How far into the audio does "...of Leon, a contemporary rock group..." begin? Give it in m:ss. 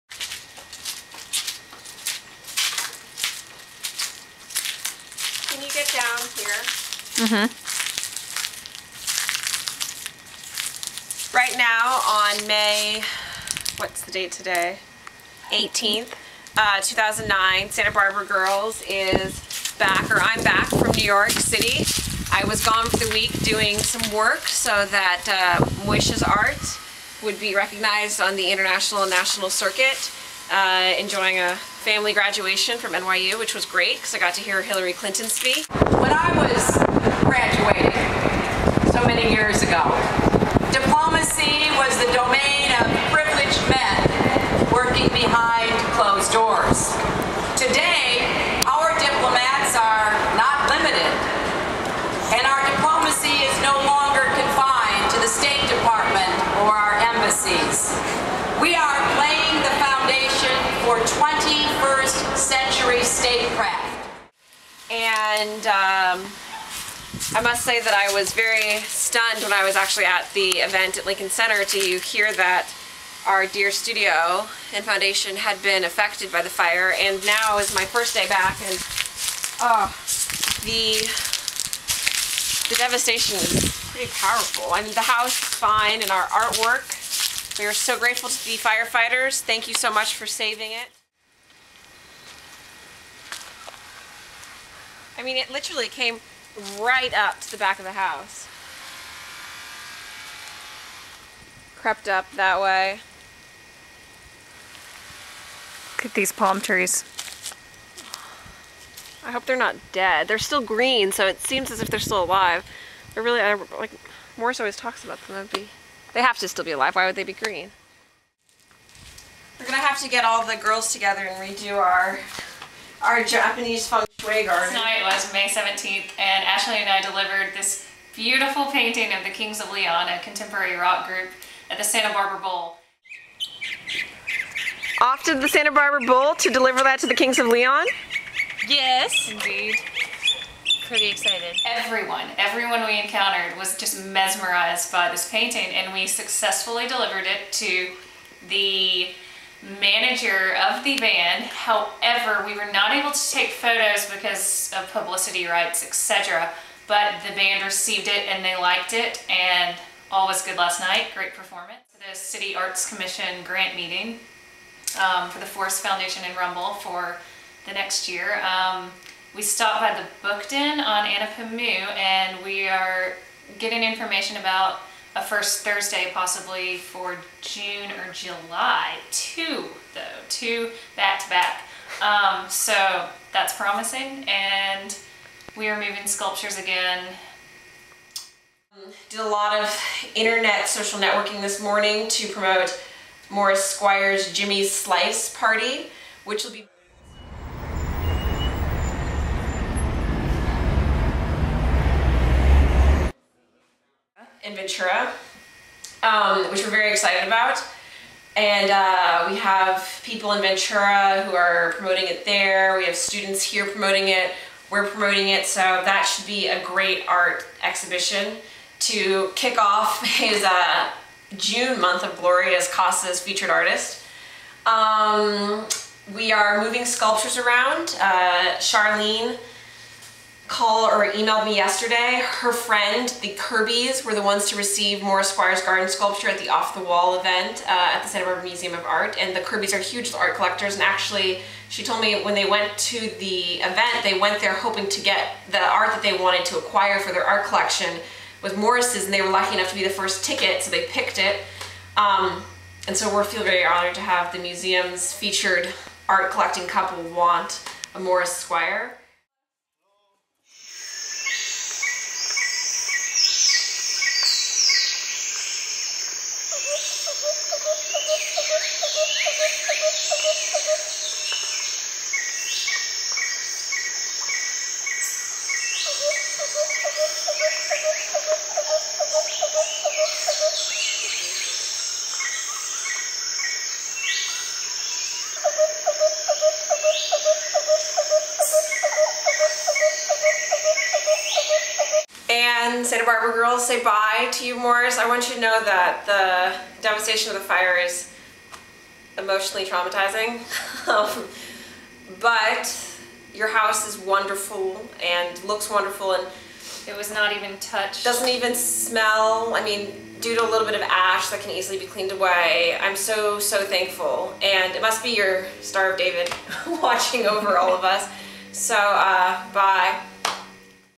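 2:09.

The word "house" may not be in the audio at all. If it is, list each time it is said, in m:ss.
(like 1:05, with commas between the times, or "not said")
1:25, 1:37, 5:03.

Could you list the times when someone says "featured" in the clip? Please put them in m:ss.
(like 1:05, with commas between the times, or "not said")
3:43, 4:15.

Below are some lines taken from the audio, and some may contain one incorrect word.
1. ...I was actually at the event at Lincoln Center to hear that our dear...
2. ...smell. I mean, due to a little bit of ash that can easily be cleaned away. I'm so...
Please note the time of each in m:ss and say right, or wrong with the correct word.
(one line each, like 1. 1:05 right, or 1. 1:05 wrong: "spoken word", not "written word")
1. 1:09 right
2. 5:08 right.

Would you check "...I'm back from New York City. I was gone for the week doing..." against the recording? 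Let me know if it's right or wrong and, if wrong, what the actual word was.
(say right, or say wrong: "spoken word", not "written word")
right.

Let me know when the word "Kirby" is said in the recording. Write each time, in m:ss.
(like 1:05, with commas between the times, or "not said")
3:53, 3:59.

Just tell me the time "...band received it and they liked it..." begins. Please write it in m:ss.
2:37.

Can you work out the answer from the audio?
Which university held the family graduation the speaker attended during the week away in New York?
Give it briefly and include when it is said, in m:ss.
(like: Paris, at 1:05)
NYU, at 0:32.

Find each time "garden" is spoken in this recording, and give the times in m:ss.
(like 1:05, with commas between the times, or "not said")
2:04, 3:55.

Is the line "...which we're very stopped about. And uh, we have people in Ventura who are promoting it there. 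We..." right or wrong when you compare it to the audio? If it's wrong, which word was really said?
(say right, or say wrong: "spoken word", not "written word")
wrong: "excited", not "stopped".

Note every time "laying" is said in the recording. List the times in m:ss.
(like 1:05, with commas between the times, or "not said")
0:59.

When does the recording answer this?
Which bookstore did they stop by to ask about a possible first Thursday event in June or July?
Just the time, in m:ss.
2:50.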